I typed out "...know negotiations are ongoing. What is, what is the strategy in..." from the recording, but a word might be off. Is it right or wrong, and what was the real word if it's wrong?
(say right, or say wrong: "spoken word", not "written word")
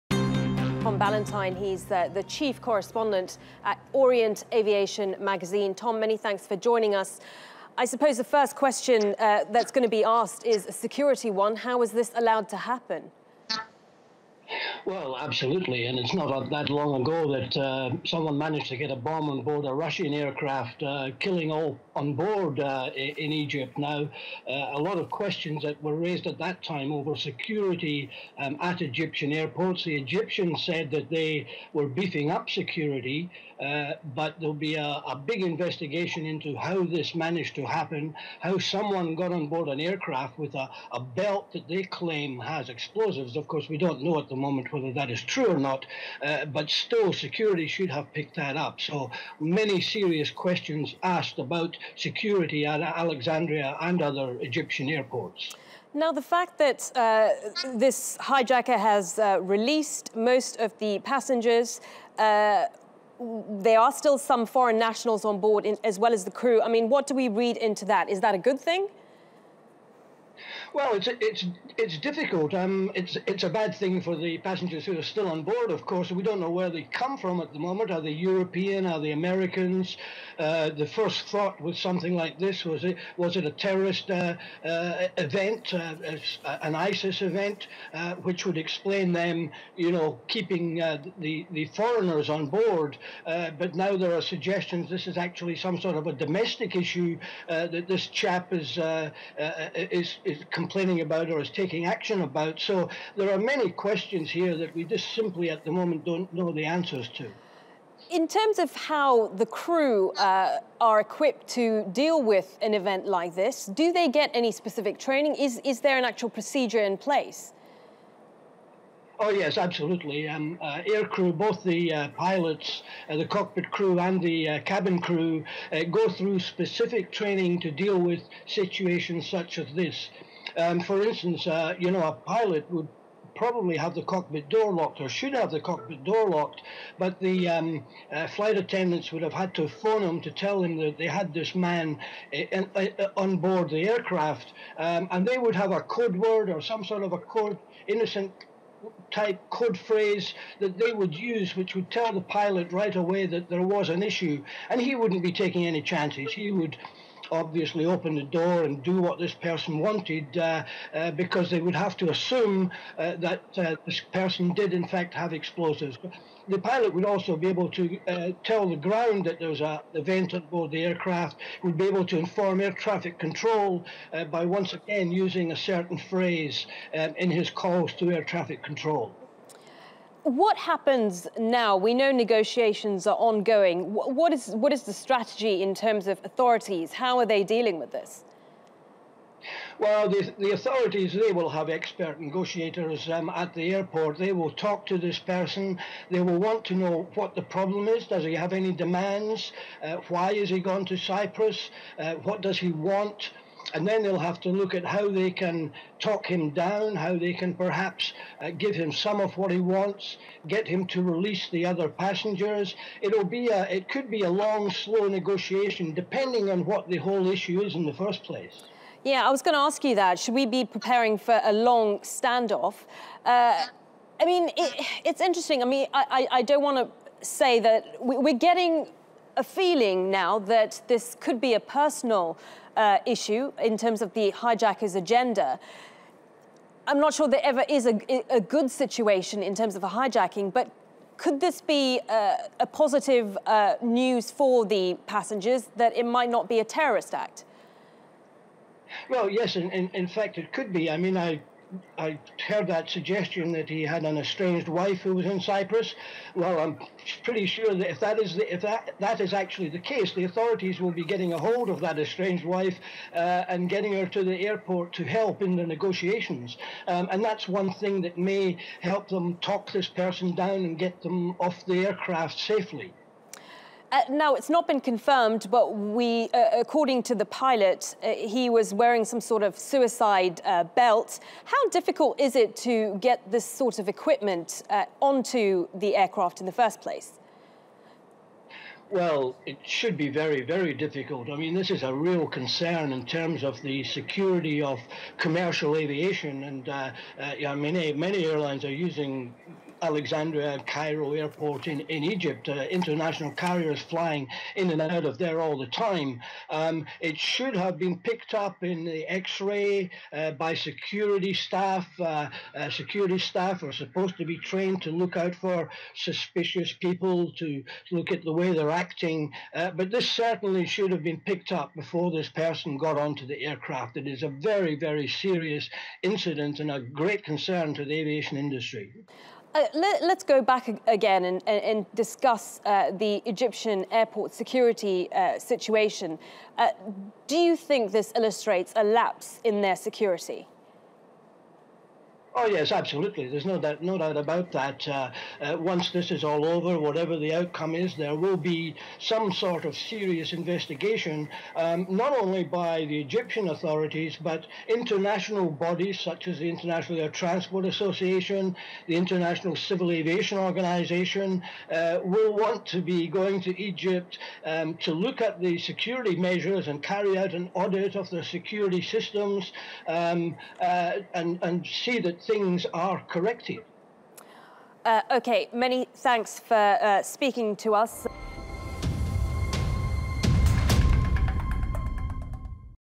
right.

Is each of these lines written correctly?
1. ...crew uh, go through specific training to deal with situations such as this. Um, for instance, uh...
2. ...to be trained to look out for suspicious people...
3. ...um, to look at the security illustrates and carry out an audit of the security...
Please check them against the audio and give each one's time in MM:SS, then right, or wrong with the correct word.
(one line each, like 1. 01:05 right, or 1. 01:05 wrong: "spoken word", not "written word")
1. 02:04 right
2. 05:14 right
3. 06:04 wrong: "measures", not "illustrates".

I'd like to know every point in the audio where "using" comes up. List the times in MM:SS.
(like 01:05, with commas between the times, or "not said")
02:55, 04:58.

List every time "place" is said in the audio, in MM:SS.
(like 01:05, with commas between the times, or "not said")
01:56, 03:38, 04:46.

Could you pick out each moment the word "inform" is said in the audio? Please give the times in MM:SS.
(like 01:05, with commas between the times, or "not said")
02:52.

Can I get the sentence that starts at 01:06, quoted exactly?
I mean, what do we read into that?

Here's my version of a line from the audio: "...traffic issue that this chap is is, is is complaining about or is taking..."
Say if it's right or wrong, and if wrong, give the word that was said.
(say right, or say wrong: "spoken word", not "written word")
wrong: "domestic", not "traffic".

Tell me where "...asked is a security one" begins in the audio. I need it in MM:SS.
00:10.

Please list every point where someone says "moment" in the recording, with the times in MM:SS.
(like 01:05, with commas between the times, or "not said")
00:44, 01:17, 01:45.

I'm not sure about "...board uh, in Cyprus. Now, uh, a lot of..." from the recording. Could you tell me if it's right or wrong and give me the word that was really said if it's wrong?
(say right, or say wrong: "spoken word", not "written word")
wrong: "Egypt", not "Cyprus".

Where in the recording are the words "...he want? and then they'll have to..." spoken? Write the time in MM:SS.
03:22.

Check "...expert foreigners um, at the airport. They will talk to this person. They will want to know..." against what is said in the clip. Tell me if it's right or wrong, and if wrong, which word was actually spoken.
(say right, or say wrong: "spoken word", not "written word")
wrong: "negotiators", not "foreigners".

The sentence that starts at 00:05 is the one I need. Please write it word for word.
Tom, many thanks for joining us.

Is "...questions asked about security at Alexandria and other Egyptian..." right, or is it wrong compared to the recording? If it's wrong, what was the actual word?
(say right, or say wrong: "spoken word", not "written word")
right.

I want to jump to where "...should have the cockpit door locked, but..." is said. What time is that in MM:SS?
02:15.